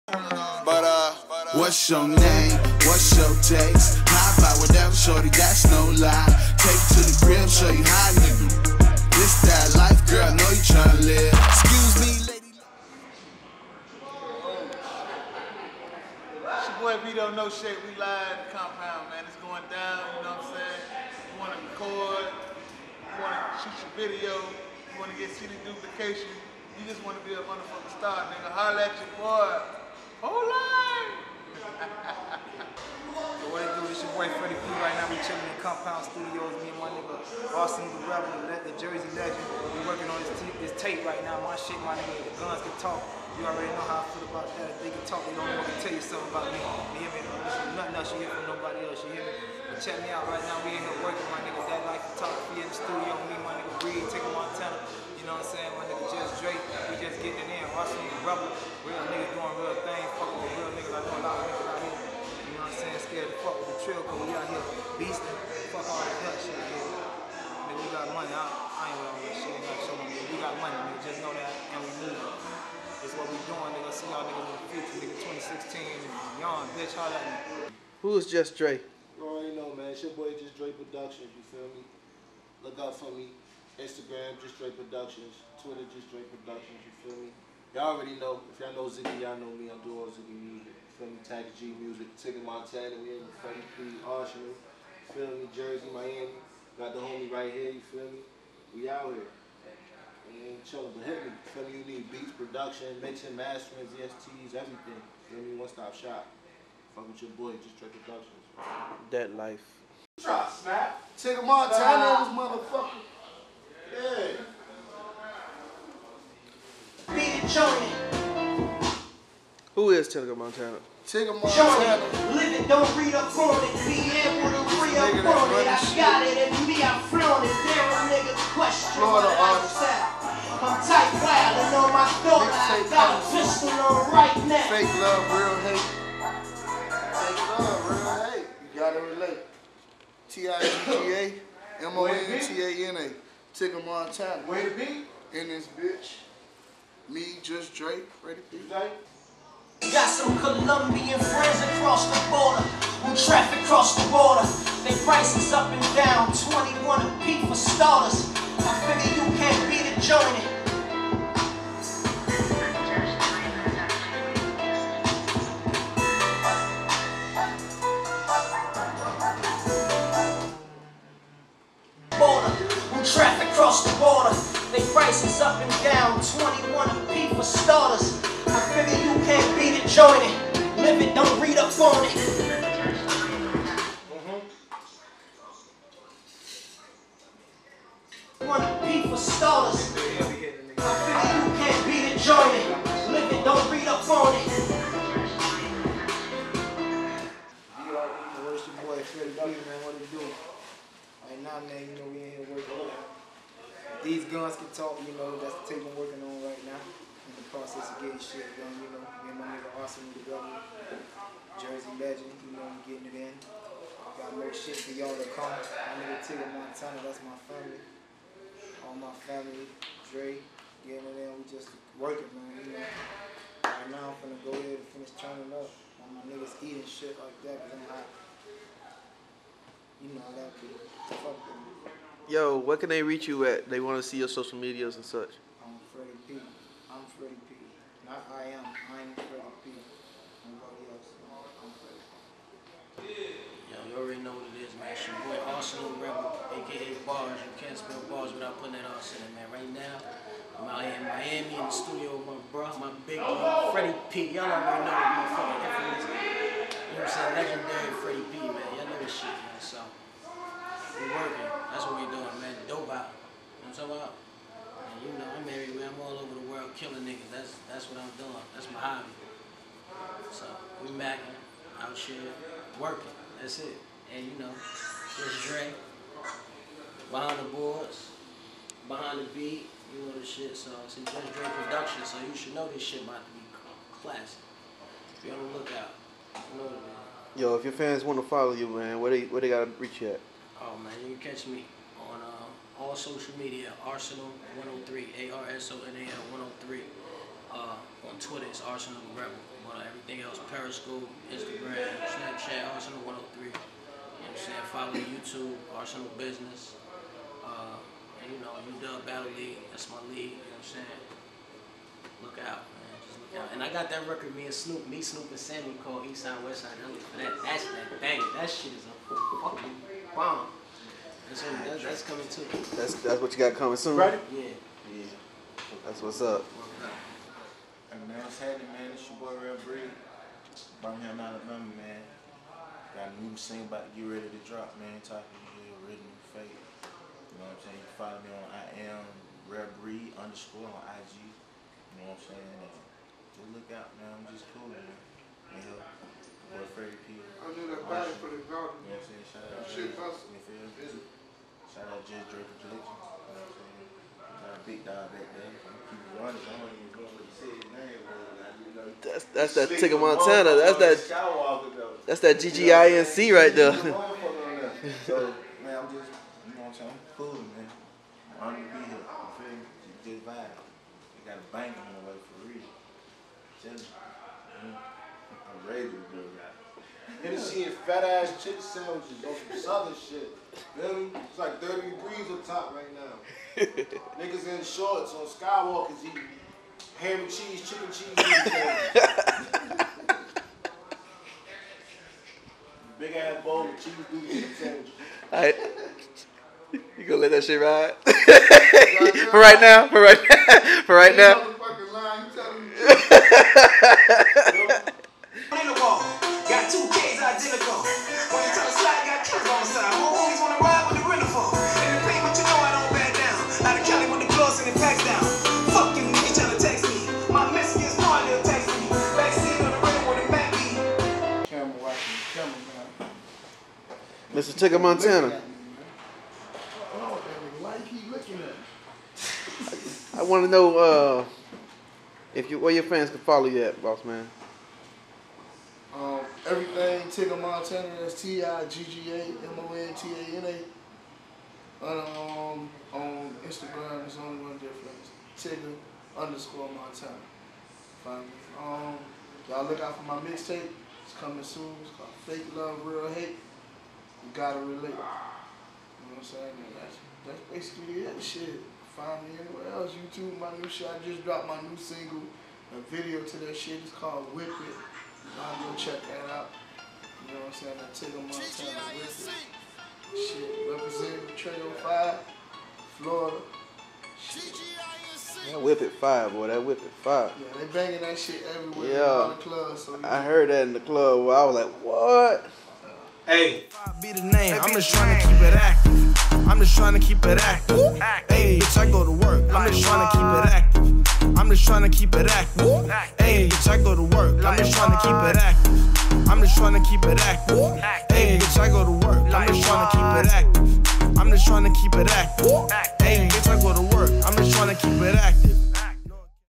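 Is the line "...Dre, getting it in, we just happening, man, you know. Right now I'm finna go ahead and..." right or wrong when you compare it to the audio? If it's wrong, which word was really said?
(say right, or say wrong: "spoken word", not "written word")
wrong: "working", not "happening".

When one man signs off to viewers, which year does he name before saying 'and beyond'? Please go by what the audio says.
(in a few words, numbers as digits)
2016.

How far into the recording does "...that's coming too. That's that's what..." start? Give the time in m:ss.
5:21.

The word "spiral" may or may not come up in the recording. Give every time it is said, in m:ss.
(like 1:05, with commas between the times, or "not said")
not said.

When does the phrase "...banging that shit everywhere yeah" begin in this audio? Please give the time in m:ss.
7:57.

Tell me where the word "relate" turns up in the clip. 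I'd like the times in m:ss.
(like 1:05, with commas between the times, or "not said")
2:19, 7:34.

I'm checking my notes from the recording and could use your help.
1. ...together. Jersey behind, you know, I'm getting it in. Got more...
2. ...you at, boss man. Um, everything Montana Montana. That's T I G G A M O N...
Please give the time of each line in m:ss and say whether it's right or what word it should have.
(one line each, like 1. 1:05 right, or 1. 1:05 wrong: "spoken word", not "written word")
1. 3:30 wrong: "legend", not "behind"
2. 7:13 wrong: "Tigga", not "Montana".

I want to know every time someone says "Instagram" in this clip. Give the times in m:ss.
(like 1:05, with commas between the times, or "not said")
1:23, 5:01, 7:23.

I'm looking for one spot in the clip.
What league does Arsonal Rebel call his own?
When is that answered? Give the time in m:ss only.
5:08.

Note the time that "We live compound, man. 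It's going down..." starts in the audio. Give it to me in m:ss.
0:17.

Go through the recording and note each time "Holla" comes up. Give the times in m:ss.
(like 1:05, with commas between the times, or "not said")
0:28, 1:16.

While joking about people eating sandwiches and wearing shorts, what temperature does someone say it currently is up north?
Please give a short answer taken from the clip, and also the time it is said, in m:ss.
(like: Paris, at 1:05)
30 degrees, at 6:21.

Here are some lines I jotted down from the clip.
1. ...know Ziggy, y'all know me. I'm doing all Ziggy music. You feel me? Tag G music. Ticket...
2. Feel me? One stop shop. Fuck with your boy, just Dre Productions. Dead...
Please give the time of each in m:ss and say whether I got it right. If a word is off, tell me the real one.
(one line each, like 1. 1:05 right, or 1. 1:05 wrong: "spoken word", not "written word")
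1. 1:28 right
2. 1:45 right.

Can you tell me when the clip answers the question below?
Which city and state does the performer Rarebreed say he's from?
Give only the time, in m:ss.
5:30.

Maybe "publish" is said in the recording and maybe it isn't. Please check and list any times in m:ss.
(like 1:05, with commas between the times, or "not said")
not said.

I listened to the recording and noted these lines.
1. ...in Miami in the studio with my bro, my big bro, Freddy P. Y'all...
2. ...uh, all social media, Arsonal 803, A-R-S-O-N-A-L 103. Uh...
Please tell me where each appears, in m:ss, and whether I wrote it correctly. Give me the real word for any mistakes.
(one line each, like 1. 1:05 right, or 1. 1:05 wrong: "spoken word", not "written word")
1. 4:11 right
2. 4:52 wrong: "103", not "803".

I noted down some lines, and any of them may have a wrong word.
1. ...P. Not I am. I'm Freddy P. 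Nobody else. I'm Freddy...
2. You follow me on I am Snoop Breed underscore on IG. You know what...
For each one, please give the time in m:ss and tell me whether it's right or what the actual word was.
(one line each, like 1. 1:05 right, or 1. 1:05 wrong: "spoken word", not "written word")
1. 3:57 right
2. 5:37 wrong: "Real", not "Snoop".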